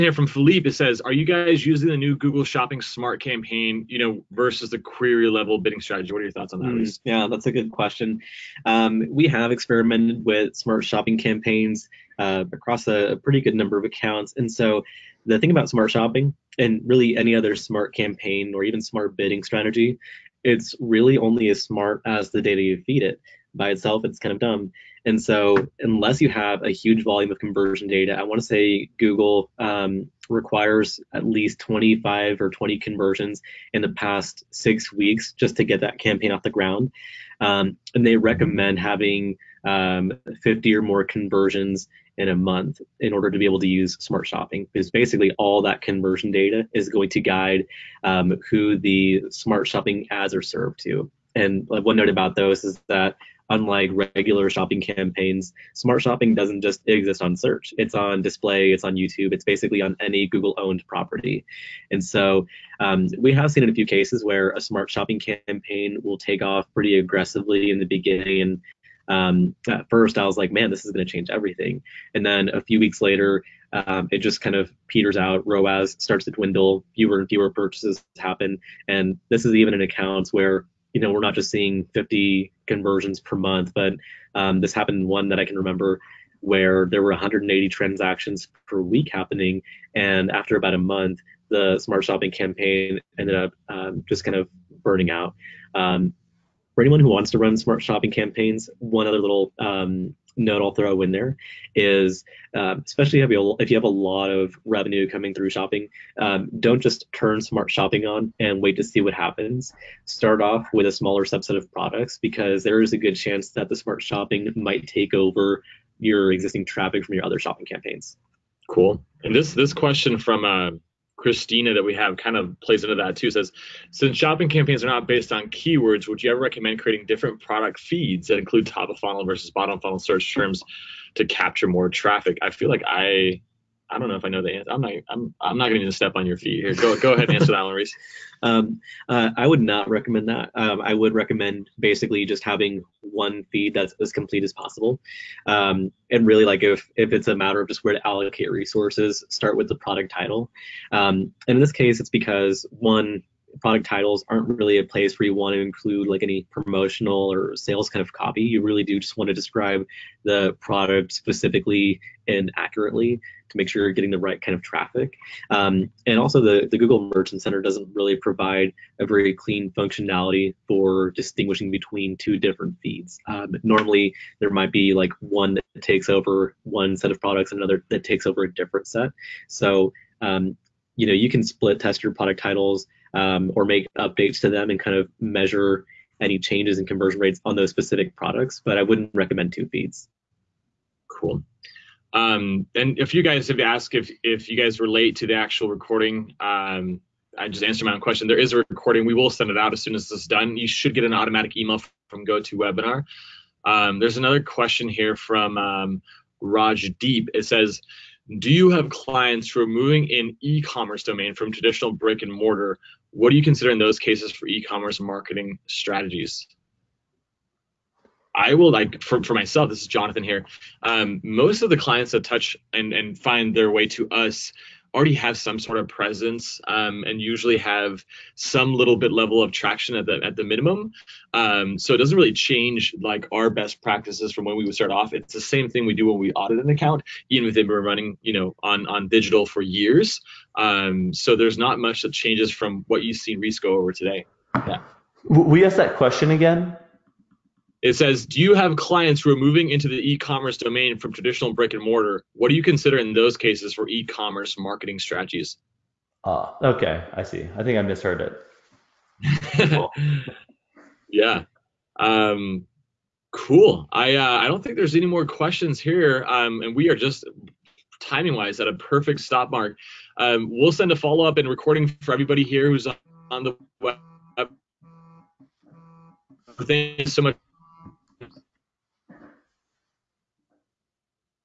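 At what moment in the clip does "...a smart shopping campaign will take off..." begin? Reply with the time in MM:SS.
01:04.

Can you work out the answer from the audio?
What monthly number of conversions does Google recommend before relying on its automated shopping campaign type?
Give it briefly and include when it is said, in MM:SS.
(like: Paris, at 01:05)
50, at 00:40.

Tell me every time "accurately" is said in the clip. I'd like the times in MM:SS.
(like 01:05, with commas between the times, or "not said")
02:42.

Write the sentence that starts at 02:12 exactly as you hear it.
I feel like I I don't know if I know the answer.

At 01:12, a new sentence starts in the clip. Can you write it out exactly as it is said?
And then a few weeks later, um, it just kind of peters out.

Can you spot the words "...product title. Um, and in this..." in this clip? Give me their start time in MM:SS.
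02:29.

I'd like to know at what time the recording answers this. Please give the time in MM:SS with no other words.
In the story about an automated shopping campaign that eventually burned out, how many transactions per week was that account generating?
01:27.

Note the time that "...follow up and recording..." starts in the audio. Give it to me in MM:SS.
04:30.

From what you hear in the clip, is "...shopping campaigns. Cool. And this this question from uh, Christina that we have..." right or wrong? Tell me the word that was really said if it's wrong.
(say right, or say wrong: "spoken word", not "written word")
right.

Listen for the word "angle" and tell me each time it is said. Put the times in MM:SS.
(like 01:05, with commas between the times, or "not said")
not said.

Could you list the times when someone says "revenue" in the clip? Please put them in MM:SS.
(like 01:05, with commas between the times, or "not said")
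01:44.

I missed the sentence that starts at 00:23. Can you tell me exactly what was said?
By itself, it's kind of dumb.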